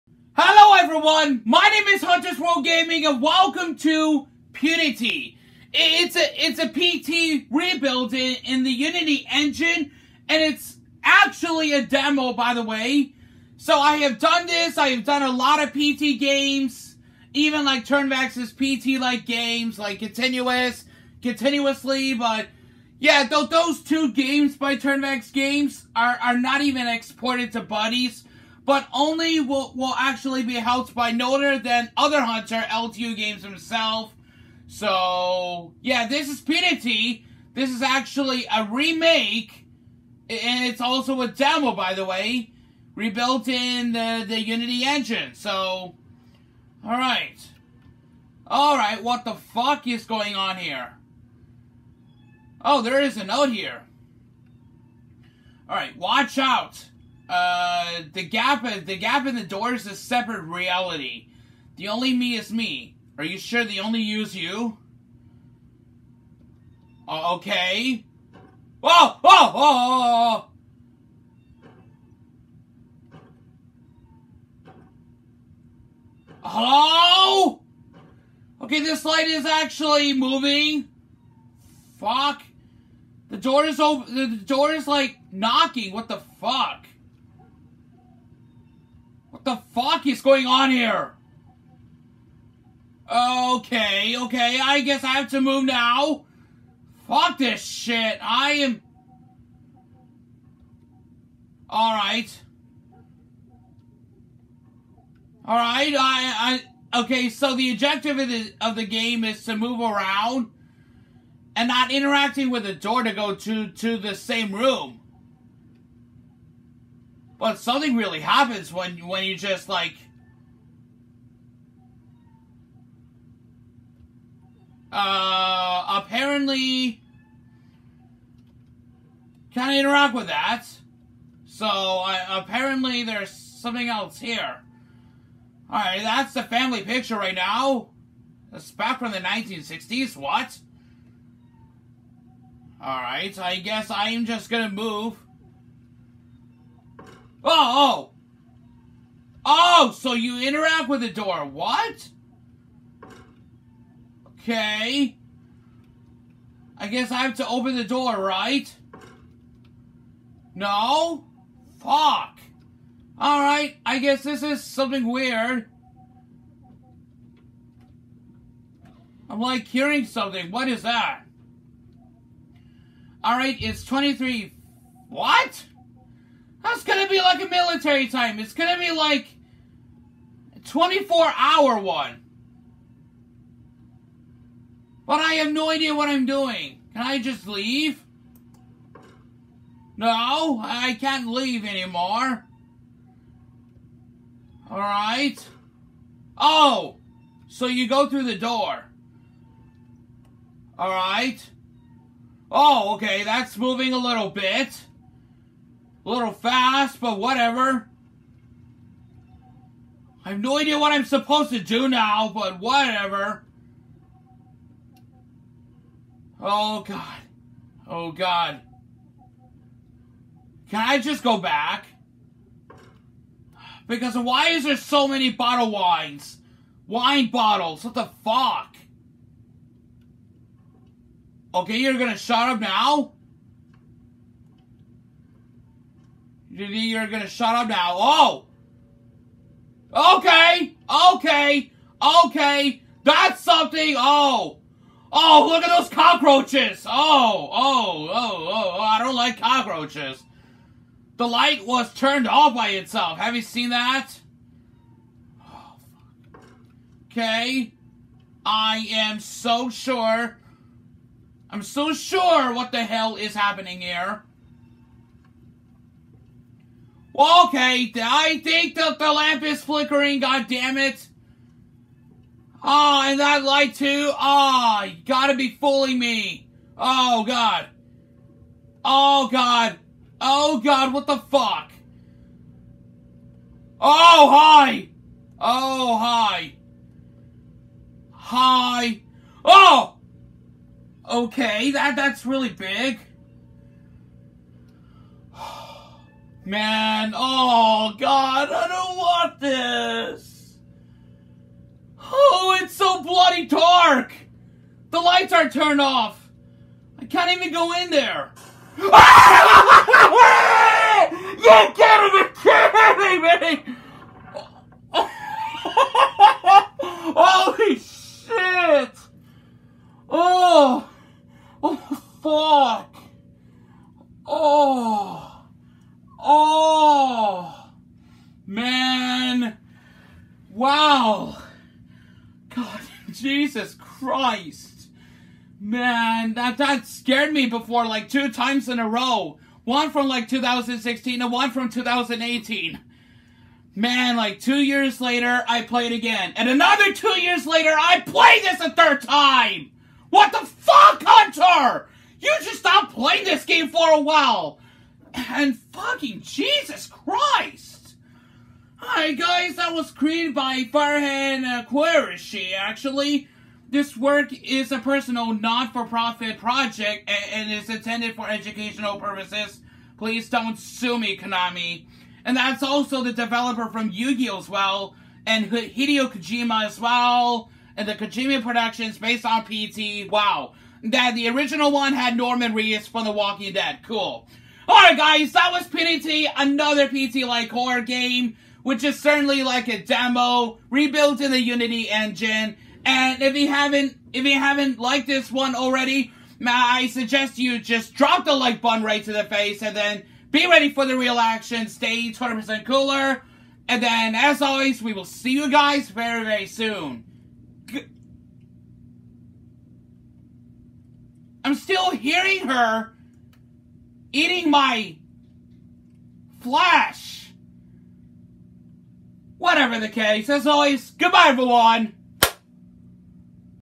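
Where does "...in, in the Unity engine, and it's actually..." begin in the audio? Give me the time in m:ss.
0:08.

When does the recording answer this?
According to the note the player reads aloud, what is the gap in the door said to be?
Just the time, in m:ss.
0:59.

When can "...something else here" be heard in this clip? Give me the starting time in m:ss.
2:13.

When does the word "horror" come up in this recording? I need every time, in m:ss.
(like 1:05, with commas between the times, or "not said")
6:27.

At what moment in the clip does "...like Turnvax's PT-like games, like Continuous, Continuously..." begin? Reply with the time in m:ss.
0:17.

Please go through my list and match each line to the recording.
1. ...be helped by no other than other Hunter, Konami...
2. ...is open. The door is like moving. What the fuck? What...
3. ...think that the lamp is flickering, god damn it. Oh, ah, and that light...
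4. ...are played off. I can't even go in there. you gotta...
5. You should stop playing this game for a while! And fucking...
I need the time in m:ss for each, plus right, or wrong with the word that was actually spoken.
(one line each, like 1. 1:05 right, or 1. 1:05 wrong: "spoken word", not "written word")
1. 0:30 wrong: "LTU", not "Konami"
2. 1:23 wrong: "knocking", not "moving"
3. 4:28 right
4. 5:05 wrong: "turned", not "played"
5. 5:52 right.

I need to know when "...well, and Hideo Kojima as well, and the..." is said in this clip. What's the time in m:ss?
6:14.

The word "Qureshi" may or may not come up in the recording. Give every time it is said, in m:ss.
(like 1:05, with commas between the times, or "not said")
6:01.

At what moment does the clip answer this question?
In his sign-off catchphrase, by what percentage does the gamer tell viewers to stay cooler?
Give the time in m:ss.
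6:42.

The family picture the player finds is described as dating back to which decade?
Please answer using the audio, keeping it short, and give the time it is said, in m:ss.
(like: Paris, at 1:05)
1960s, at 2:19.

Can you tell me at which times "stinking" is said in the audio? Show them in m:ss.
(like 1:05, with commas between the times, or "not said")
not said.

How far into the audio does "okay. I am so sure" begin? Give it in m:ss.
4:17.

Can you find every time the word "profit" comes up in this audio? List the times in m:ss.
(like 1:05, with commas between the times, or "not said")
6:05.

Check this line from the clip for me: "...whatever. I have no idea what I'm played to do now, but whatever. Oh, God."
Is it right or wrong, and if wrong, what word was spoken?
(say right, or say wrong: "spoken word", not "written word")
wrong: "supposed", not "played".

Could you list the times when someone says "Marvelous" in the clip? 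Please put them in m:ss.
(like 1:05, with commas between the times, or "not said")
not said.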